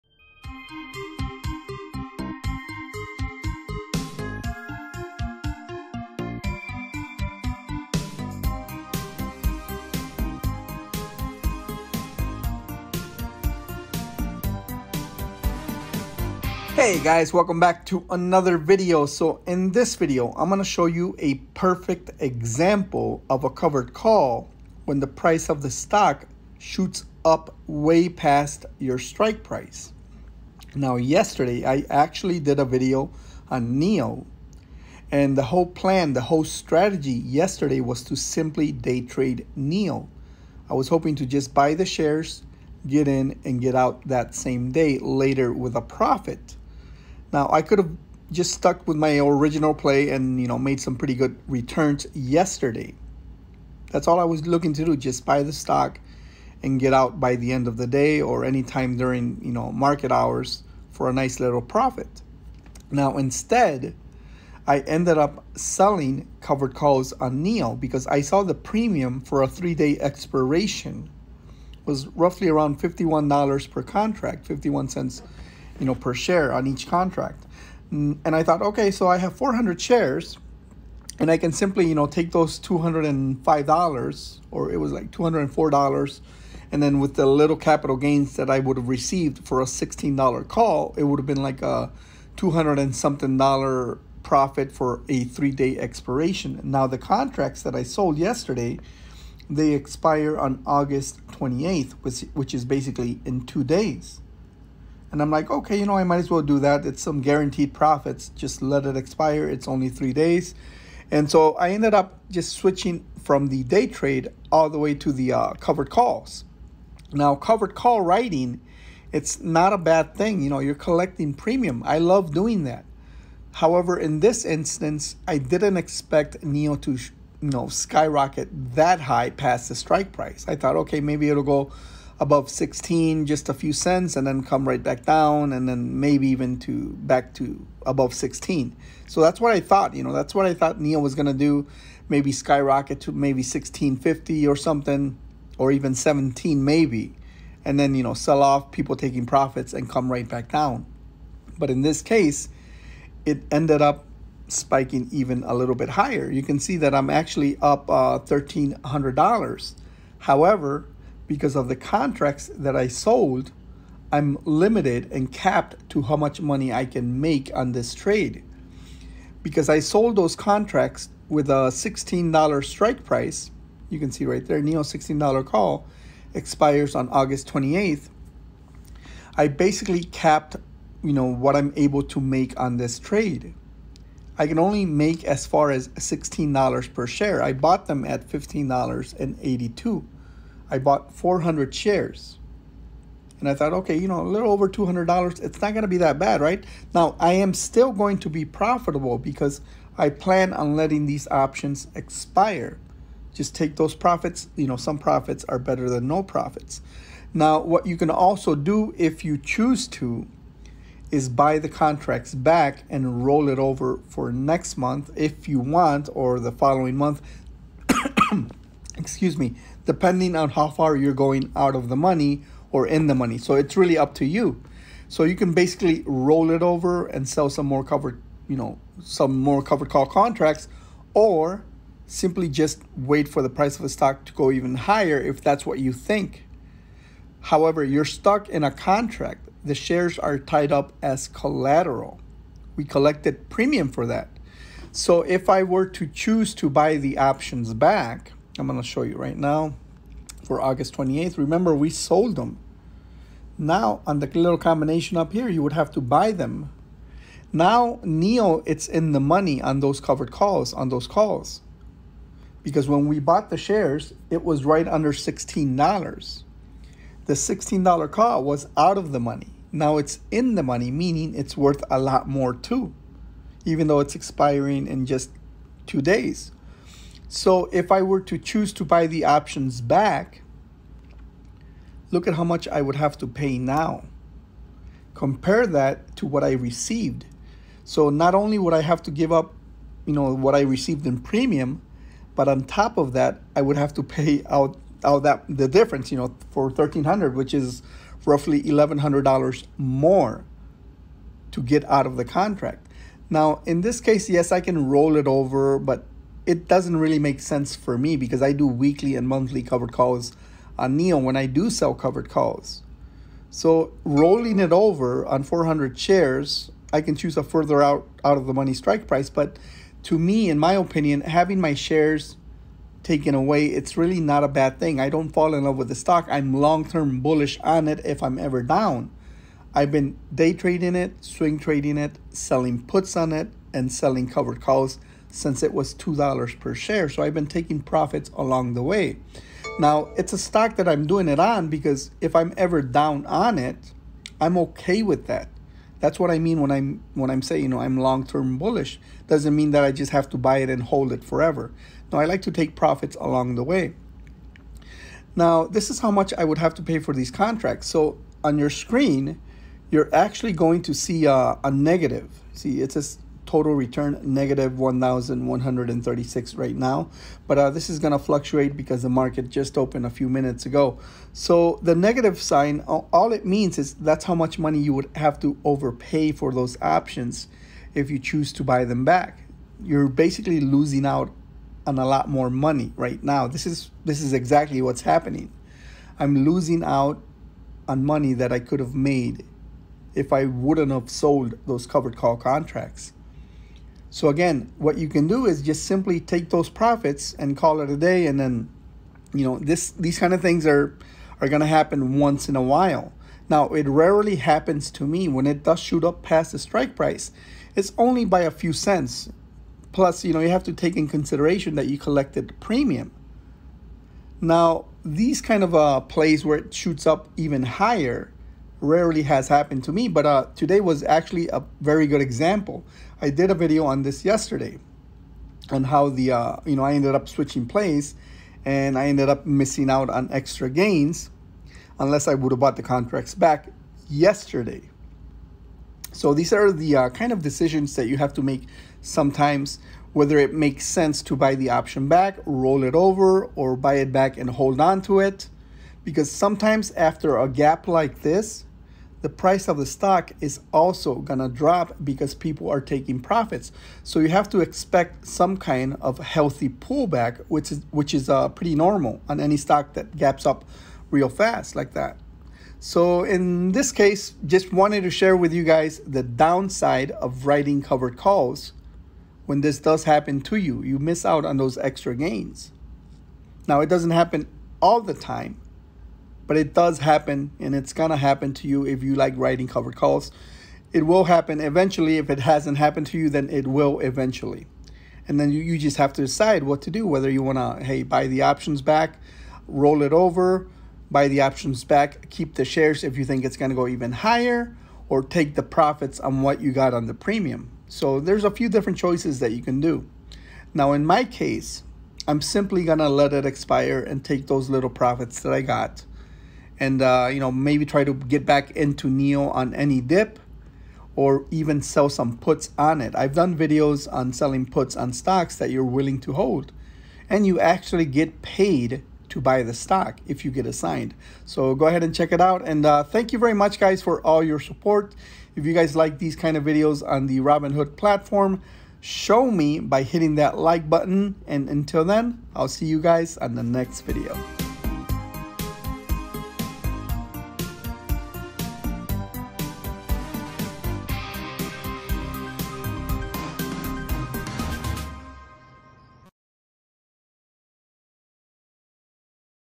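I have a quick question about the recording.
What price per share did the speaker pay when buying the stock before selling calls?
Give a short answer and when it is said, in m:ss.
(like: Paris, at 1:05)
$15.82, at 3:08.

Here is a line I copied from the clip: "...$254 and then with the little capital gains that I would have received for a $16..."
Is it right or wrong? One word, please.
wrong.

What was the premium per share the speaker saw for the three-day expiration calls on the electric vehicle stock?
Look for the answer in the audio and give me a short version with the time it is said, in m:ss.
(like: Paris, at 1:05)
51 cents, at 1:14.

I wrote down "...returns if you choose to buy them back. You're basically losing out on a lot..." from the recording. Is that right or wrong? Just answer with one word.
wrong.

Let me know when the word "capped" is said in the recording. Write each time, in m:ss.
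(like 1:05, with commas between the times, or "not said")
2:45, 3:00.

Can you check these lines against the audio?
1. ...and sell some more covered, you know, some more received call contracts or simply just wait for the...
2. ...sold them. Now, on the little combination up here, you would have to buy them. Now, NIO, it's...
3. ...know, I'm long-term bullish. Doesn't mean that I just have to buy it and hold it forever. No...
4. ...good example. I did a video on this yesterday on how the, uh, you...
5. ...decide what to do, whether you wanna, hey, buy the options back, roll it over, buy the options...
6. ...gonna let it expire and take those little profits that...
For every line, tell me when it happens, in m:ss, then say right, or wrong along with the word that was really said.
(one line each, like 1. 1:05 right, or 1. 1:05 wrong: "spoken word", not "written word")
1. 3:47 wrong: "covered", not "received"
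2. 4:11 right
3. 5:47 right
4. 7:02 right
5. 8:06 right
6. 8:22 right.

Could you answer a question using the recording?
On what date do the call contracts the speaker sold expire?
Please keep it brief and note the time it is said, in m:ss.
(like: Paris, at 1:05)
August 28th, at 1:40.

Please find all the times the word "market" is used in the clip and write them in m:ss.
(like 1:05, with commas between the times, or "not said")
0:59, 6:09.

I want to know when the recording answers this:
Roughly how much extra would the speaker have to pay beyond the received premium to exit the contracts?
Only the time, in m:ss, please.
4:58.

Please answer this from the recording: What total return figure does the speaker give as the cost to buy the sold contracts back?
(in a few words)
-1,136.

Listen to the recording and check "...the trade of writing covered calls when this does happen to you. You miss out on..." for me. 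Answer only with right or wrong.
wrong.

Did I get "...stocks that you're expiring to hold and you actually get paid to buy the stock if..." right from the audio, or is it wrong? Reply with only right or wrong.
wrong.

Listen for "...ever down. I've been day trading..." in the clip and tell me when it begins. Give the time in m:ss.
5:28.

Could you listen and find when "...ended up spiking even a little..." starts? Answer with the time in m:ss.
2:33.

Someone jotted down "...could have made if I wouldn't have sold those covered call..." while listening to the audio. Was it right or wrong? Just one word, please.
right.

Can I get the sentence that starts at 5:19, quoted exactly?
But to me, in my opinion, having my shares taken away, it's really not a bad thing.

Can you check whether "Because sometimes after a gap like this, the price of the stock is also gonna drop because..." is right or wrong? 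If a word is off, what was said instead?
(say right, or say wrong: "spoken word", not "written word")
right.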